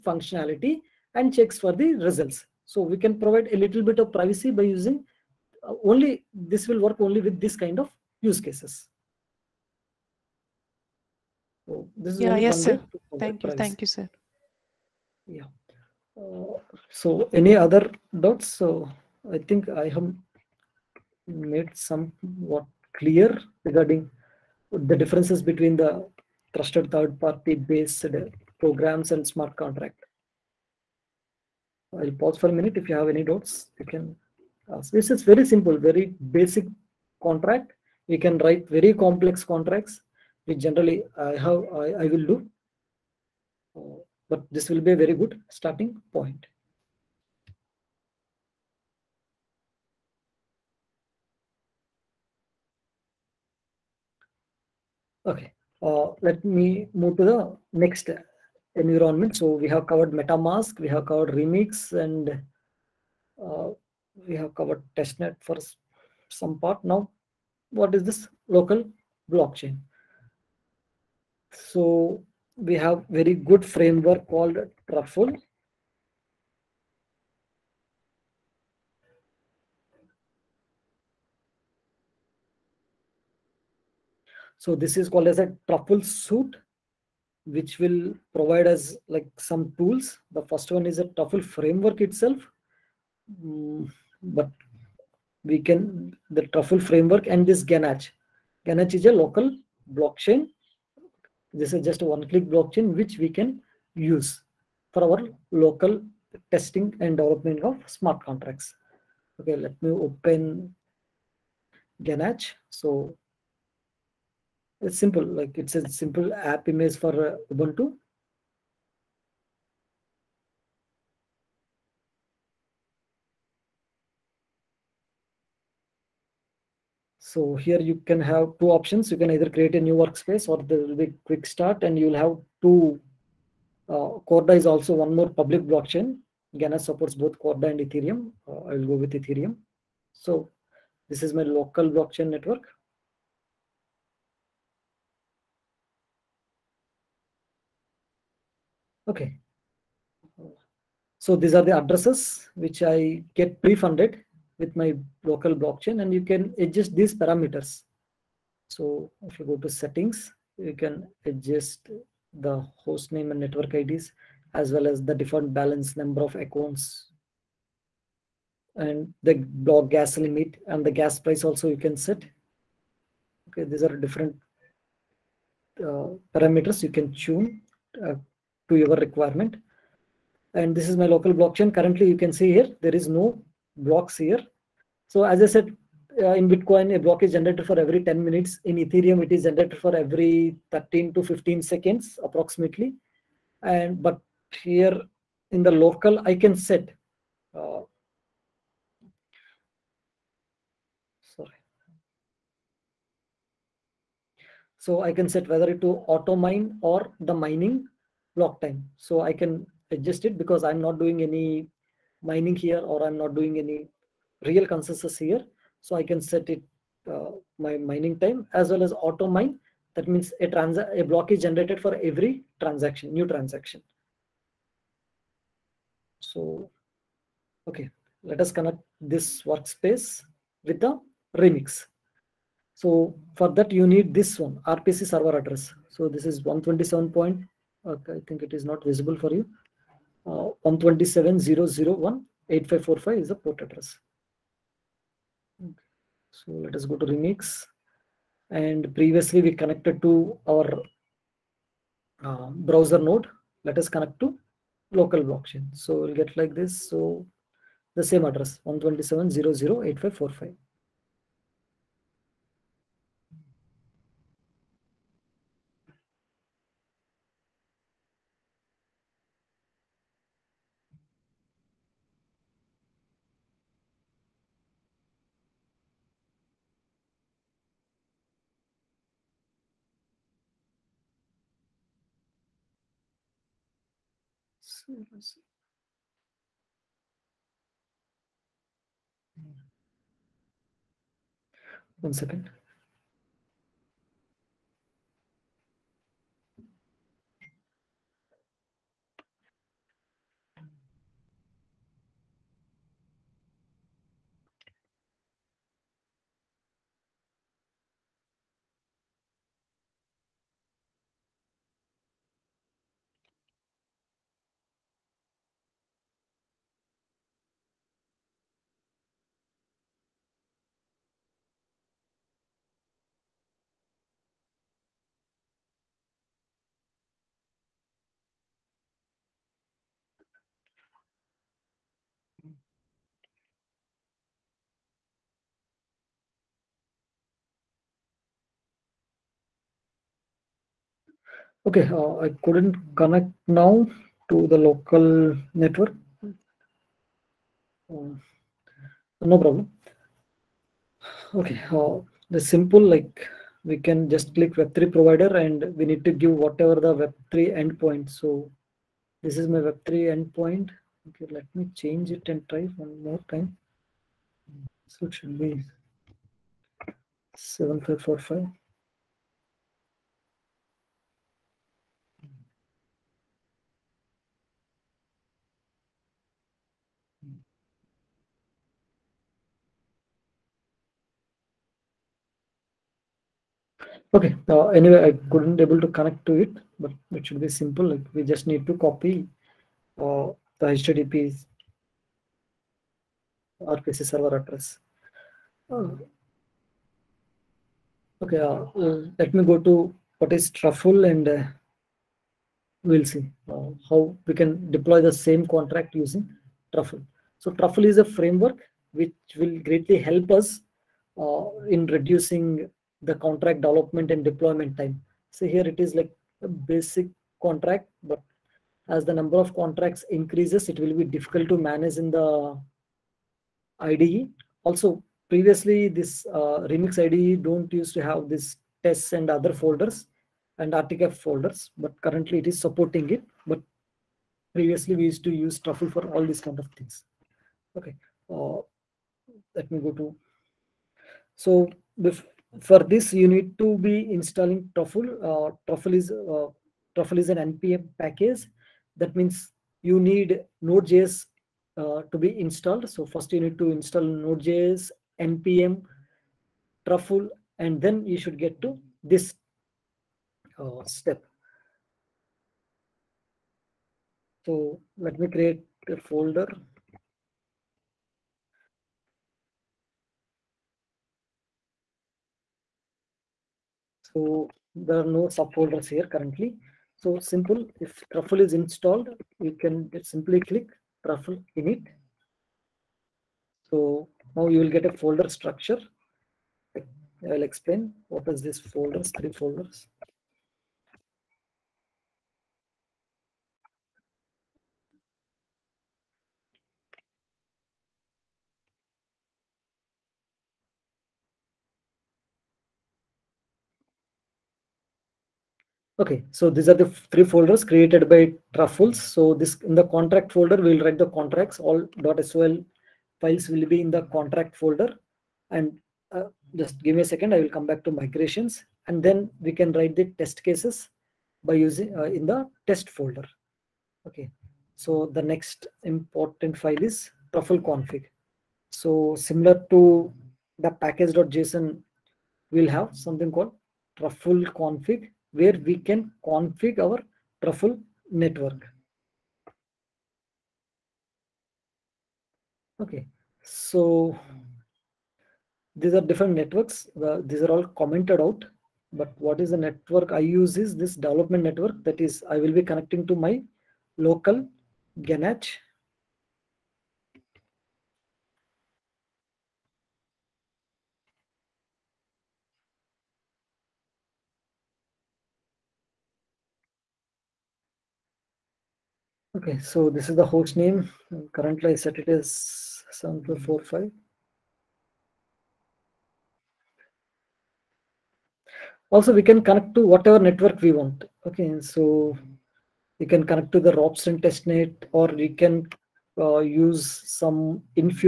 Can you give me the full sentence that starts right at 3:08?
In Ethereum, it is generated for every 13 to 15 seconds approximately.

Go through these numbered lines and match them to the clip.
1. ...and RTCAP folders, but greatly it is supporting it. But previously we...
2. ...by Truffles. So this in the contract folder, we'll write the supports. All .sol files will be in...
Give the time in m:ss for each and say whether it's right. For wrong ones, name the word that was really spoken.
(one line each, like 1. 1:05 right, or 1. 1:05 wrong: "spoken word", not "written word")
1. 7:10 wrong: "currently", not "greatly"
2. 8:28 wrong: "contracts", not "supports".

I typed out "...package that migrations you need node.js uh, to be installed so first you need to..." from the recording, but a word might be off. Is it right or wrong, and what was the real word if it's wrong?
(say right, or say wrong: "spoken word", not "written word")
wrong: "means", not "migrations".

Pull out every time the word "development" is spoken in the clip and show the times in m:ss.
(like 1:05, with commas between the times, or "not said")
1:47, 6:53, 9:10.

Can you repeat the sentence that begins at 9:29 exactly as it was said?
Okay, so this is the host name.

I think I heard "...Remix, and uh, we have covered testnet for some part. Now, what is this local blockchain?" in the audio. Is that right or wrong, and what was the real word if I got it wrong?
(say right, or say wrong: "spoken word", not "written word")
right.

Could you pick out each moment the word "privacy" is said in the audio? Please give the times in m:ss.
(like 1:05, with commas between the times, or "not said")
0:04, 0:13.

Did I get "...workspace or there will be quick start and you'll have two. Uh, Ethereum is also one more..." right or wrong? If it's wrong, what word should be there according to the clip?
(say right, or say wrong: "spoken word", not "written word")
wrong: "Corda", not "Ethereum".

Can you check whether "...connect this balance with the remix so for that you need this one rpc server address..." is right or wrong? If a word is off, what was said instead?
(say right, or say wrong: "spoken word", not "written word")
wrong: "workspace", not "balance".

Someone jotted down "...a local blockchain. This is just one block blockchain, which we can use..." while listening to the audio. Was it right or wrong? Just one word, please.
wrong.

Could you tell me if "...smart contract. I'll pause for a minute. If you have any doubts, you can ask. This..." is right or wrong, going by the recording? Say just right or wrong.
right.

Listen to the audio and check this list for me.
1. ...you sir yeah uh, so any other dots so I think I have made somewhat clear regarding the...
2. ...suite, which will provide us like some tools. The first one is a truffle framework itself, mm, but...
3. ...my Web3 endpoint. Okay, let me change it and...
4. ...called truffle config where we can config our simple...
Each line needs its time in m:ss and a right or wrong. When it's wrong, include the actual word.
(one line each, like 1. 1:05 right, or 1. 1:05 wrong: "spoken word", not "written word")
1. 0:13 right
2. 1:26 right
3. 5:59 right
4. 8:53 wrong: "truffle", not "simple".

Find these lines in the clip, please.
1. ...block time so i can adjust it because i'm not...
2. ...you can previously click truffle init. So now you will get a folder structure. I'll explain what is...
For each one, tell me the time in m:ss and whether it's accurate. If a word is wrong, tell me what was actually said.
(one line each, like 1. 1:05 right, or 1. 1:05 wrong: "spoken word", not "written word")
1. 3:28 right
2. 7:59 wrong: "simply", not "previously".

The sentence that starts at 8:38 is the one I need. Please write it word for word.
And then we can write the test cases by using uh, in the test folder.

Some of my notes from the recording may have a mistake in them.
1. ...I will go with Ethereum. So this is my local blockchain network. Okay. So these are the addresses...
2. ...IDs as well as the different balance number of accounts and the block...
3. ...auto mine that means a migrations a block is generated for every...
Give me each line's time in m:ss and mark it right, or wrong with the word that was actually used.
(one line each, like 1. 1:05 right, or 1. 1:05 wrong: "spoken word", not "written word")
1. 2:18 right
2. 2:43 right
3. 3:38 wrong: "trans", not "migrations".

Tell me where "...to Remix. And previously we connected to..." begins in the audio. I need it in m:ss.
4:06.